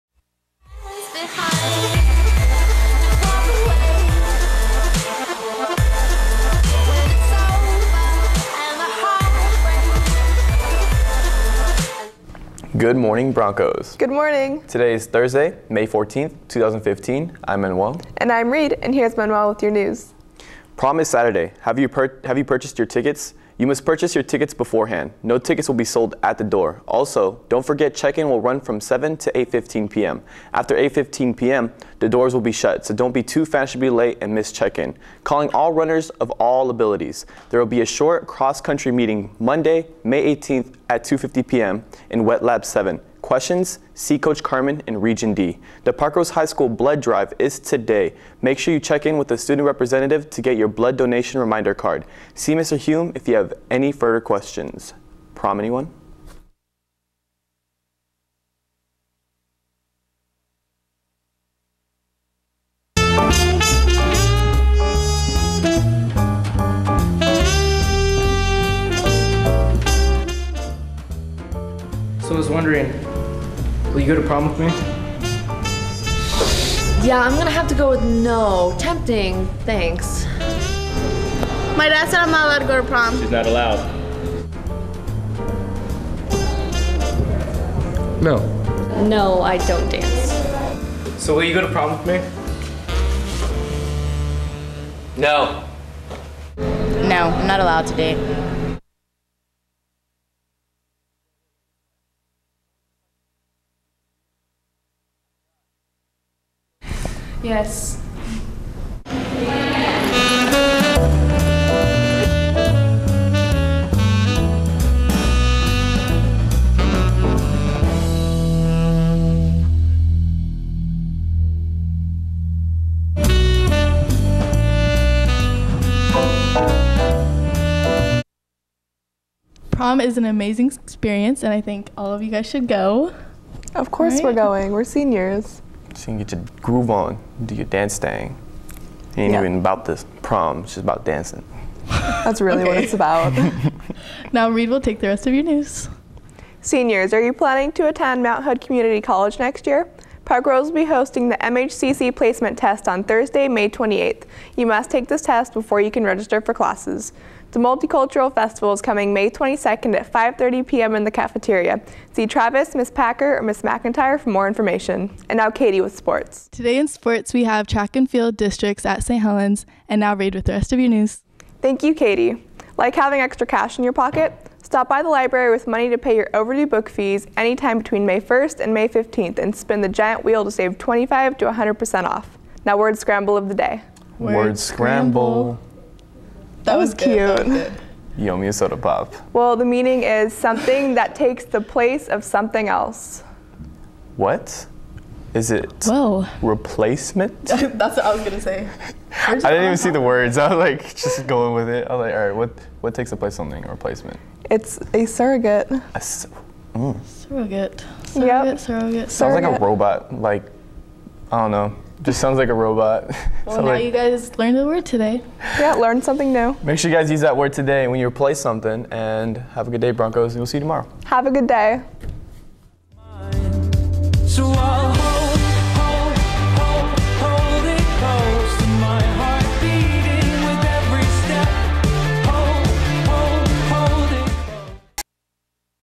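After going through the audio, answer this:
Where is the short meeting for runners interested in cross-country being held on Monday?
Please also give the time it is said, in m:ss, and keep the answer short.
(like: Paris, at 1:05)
Wet Lab 7, at 0:42.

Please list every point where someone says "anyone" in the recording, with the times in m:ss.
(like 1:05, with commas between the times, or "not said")
0:55.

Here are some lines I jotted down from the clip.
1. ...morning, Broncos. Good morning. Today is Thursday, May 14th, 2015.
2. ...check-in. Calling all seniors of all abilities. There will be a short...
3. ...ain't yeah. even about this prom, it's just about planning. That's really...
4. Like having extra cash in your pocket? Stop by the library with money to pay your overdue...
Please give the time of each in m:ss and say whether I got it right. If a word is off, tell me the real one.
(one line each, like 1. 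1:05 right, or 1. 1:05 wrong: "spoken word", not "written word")
1. 0:12 right
2. 0:34 wrong: "runners", not "seniors"
3. 2:19 wrong: "dancing", not "planning"
4. 2:52 right.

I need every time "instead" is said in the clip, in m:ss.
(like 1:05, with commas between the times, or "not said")
not said.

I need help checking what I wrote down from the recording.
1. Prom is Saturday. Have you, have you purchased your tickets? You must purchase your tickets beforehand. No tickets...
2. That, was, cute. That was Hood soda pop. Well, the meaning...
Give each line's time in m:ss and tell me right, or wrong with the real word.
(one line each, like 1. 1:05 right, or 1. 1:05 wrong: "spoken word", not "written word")
1. 0:20 right
2. 3:06 wrong: "Yummy", not "Hood".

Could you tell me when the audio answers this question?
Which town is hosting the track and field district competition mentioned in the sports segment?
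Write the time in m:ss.
2:49.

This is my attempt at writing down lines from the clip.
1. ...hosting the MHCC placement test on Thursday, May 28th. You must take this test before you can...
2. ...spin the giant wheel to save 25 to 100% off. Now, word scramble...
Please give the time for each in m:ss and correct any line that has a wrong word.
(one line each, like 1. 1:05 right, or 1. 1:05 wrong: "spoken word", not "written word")
1. 2:30 right
2. 2:59 right.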